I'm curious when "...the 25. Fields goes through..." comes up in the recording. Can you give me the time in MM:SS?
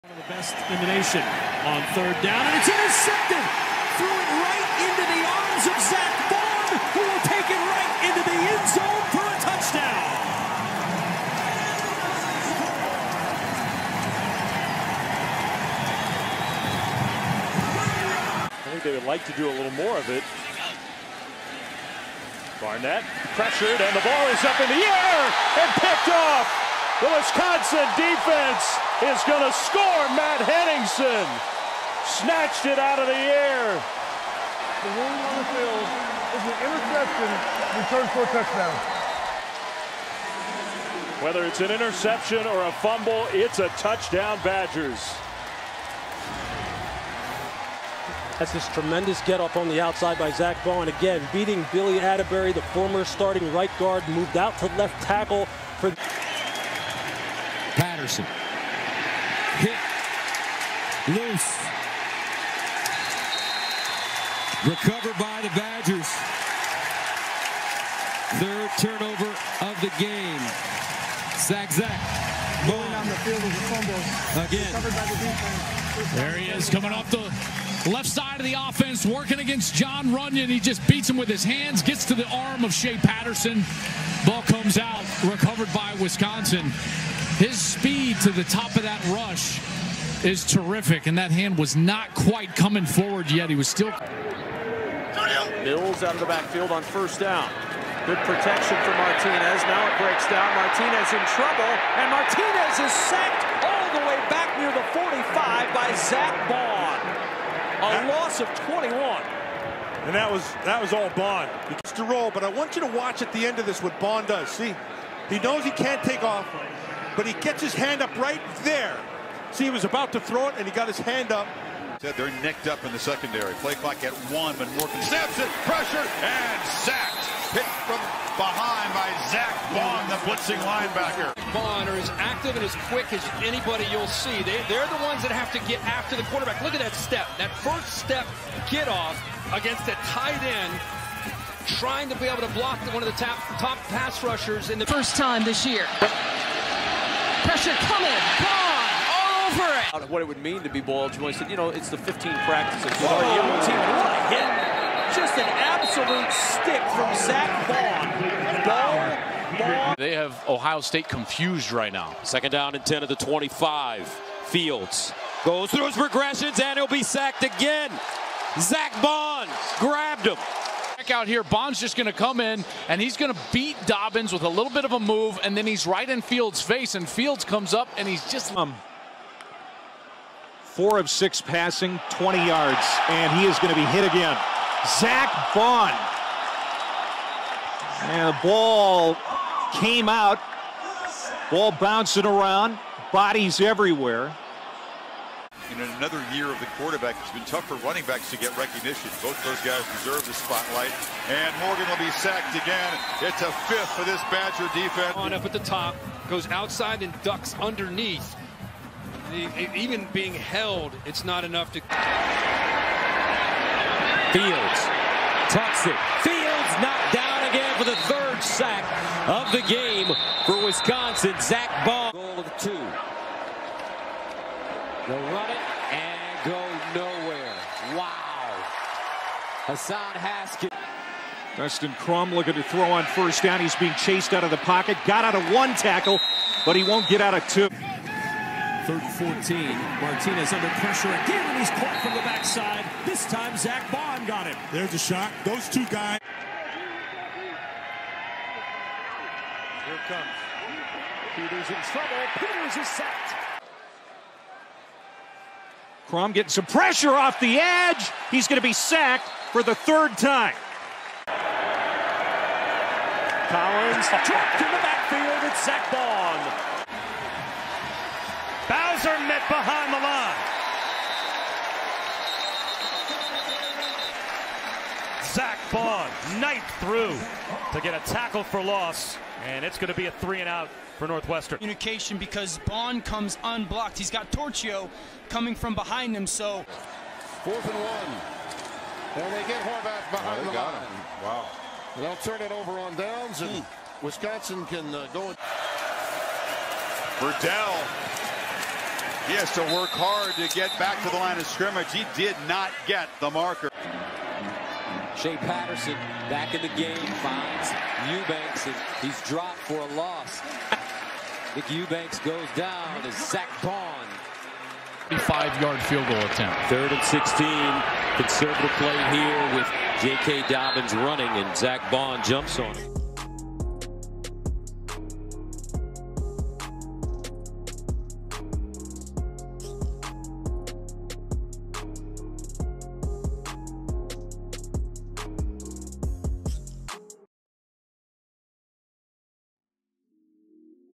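02:43.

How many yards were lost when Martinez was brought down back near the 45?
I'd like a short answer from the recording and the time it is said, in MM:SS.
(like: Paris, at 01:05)
21, at 01:47.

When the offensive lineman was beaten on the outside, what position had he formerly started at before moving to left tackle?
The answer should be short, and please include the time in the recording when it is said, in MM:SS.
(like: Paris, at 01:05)
Right guard, at 00:53.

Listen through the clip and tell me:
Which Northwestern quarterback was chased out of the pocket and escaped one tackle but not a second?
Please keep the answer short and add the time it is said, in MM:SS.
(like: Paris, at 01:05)
Dustin Crum, at 03:51.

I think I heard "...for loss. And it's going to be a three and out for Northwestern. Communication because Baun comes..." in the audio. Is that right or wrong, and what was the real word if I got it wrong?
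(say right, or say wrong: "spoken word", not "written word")
right.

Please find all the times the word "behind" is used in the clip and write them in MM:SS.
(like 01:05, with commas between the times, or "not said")
02:08, 04:29, 04:45, 04:50.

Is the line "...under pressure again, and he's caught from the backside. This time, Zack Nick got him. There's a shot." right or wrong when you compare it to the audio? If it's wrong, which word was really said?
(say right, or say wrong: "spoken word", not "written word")
wrong: "Baun", not "Nick".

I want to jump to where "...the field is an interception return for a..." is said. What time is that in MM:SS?
00:35.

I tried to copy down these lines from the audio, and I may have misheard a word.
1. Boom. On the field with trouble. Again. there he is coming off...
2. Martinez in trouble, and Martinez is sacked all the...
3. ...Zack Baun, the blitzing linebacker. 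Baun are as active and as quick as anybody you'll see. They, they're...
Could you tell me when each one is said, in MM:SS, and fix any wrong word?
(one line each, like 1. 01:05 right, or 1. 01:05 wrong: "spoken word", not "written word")
1. 01:12 wrong: "fumble", not "trouble"
2. 01:40 right
3. 02:09 right.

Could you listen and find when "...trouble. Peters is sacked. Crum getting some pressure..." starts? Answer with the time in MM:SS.
04:11.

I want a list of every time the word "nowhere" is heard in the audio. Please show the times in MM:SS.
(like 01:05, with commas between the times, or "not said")
03:46.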